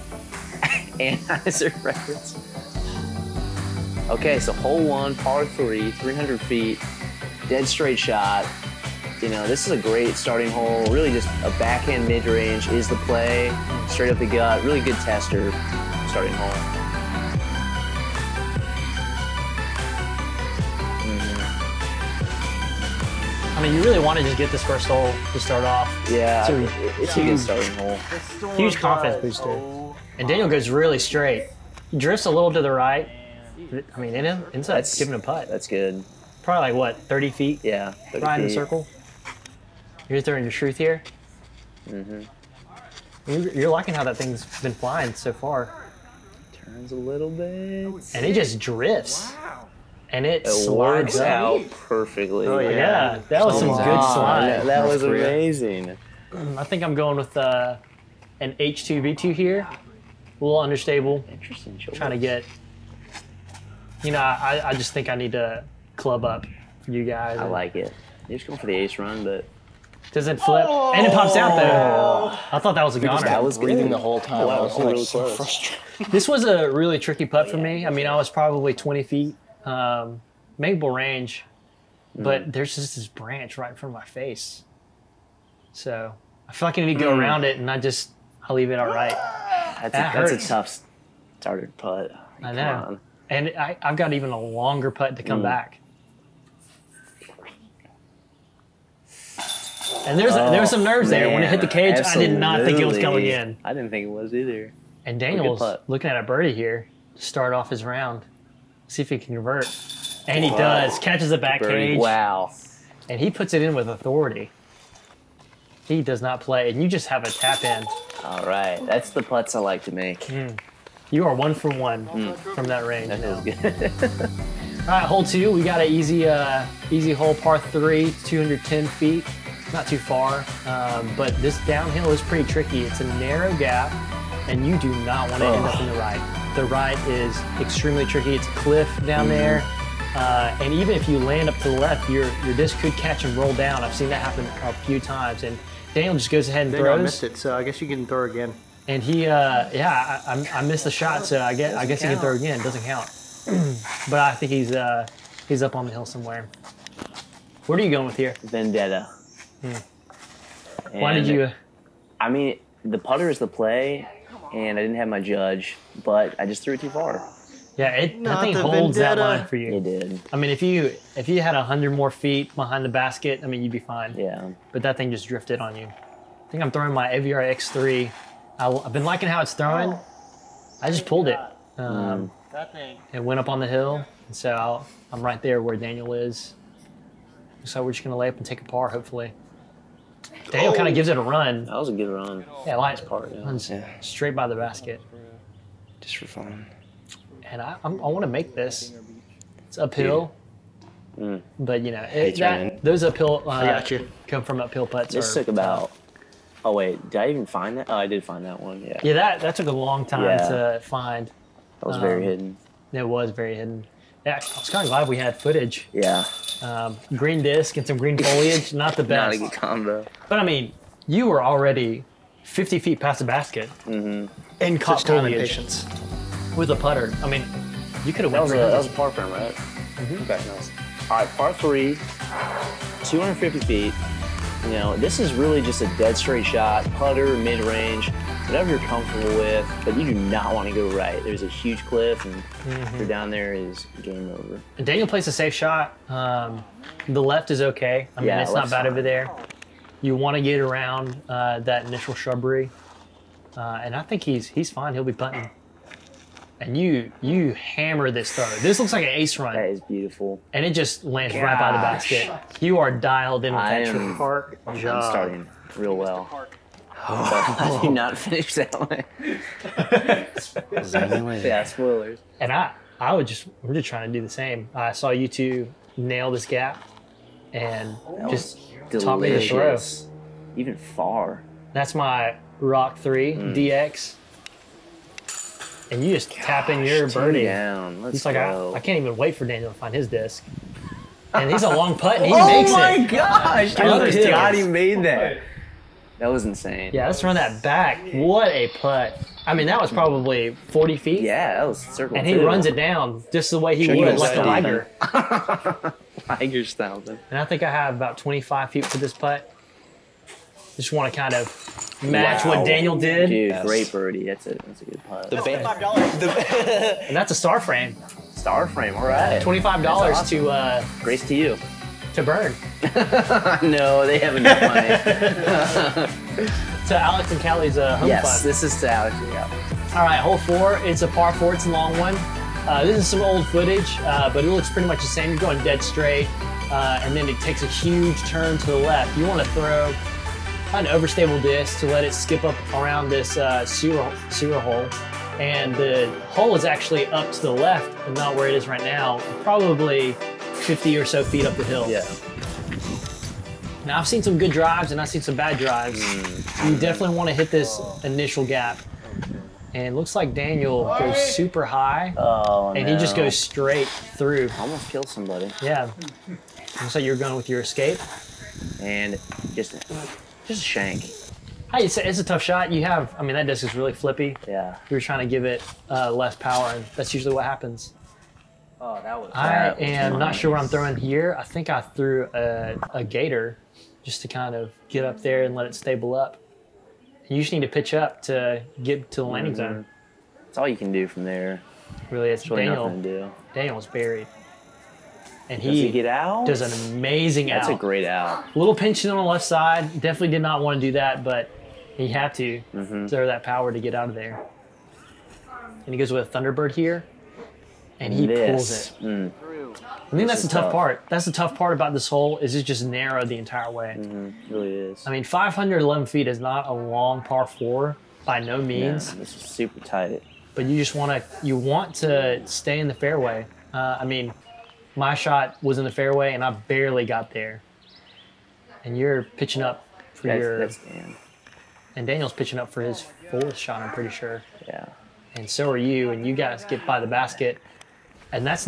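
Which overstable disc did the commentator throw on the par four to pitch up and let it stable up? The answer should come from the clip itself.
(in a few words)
Gator.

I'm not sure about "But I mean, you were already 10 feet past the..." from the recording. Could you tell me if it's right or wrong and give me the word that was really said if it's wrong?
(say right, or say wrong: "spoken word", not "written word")
wrong: "50", not "10".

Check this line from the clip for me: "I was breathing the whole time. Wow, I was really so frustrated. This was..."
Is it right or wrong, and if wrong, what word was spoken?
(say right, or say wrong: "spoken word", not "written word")
right.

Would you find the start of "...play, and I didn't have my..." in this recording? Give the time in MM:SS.
02:43.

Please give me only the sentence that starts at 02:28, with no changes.
And he, uh, yeah, I, I, I missed the shot, so I guess I guess he can throw again.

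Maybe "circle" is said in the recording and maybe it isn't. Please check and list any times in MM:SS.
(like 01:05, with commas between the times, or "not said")
00:38, 05:01.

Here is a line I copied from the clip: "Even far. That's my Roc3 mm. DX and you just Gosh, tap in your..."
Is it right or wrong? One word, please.
right.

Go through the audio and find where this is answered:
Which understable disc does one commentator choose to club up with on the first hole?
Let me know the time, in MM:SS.
00:58.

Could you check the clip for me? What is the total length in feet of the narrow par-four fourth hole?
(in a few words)
511 feet.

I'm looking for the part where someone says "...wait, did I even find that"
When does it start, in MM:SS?
03:26.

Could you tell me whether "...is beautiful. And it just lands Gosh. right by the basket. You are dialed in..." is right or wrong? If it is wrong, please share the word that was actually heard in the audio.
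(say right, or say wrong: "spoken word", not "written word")
right.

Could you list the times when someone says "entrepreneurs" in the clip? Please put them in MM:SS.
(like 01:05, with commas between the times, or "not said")
not said.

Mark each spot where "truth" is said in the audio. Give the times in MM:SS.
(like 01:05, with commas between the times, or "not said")
00:40.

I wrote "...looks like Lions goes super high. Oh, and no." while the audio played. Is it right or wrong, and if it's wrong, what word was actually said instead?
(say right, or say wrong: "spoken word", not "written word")
wrong: "Daniel", not "Lions".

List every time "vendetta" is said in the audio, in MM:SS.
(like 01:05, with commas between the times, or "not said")
02:38, 02:48.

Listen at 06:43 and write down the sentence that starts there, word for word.
throw that power to get out of there.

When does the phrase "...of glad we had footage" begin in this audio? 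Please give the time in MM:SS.
03:34.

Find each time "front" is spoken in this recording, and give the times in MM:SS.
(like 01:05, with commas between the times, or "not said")
01:23.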